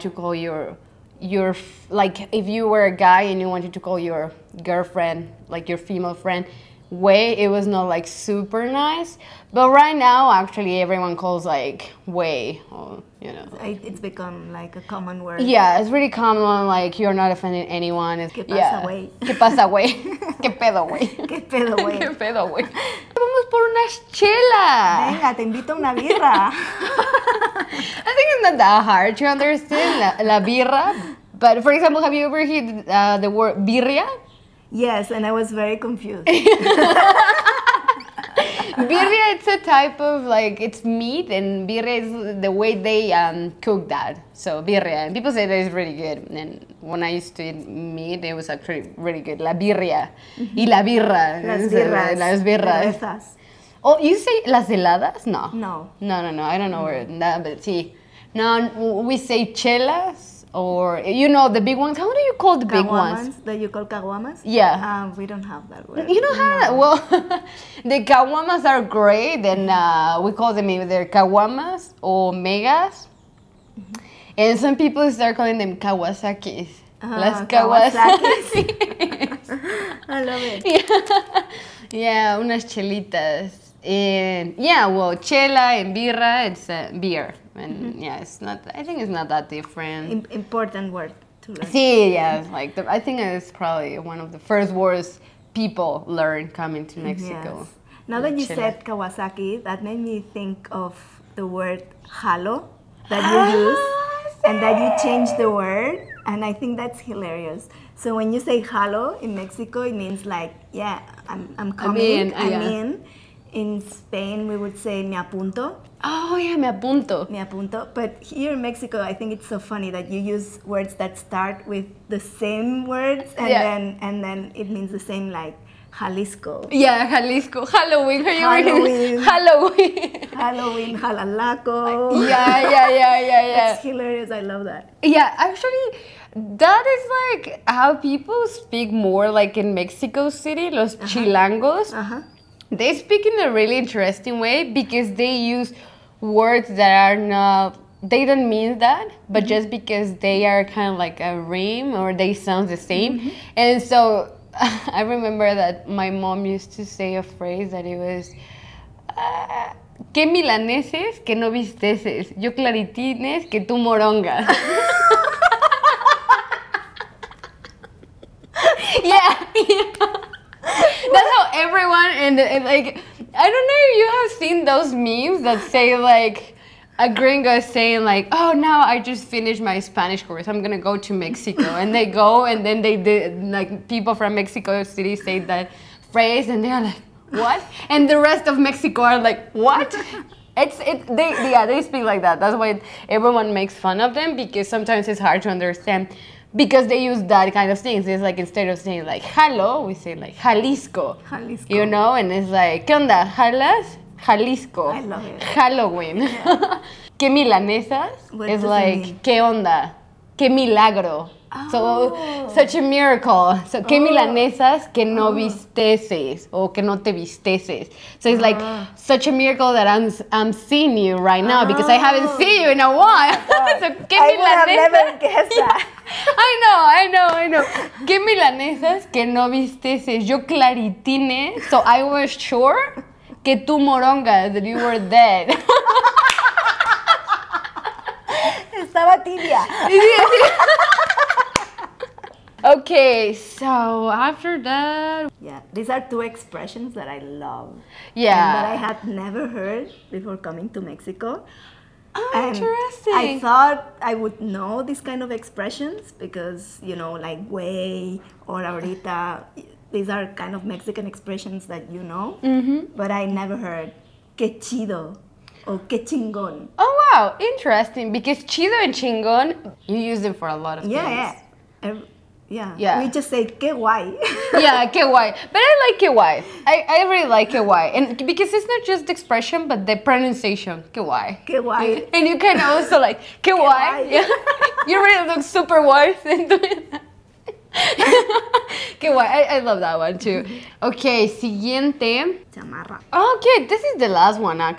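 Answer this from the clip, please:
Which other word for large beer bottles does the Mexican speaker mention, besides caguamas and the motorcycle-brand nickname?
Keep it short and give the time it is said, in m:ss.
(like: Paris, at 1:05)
megas, at 1:12.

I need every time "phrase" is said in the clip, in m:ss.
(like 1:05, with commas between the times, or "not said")
2:37, 3:06.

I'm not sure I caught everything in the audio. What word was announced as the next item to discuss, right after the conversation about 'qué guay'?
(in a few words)
chamarra.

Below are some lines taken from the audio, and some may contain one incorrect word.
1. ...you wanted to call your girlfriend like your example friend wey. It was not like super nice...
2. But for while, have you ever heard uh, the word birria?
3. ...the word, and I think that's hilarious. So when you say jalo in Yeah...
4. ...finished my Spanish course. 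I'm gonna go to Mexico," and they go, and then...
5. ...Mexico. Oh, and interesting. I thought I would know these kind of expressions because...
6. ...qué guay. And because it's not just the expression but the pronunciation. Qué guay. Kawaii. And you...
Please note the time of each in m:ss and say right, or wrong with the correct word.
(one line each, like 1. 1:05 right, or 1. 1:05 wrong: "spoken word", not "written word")
1. 0:03 wrong: "female", not "example"
2. 0:31 wrong: "example", not "while"
3. 1:45 wrong: "Mexico", not "Yeah"
4. 2:59 right
5. 4:10 right
6. 4:37 right.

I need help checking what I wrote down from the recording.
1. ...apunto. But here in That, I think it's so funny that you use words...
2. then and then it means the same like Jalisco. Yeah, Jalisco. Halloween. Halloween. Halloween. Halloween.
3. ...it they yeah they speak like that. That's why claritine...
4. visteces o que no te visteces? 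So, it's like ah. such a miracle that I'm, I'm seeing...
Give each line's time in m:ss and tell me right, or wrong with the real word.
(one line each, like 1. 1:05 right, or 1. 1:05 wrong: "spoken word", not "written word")
1. 1:57 wrong: "Mexico", not "That"
2. 2:03 right
3. 3:10 wrong: "everyone", not "claritine"
4. 3:35 right.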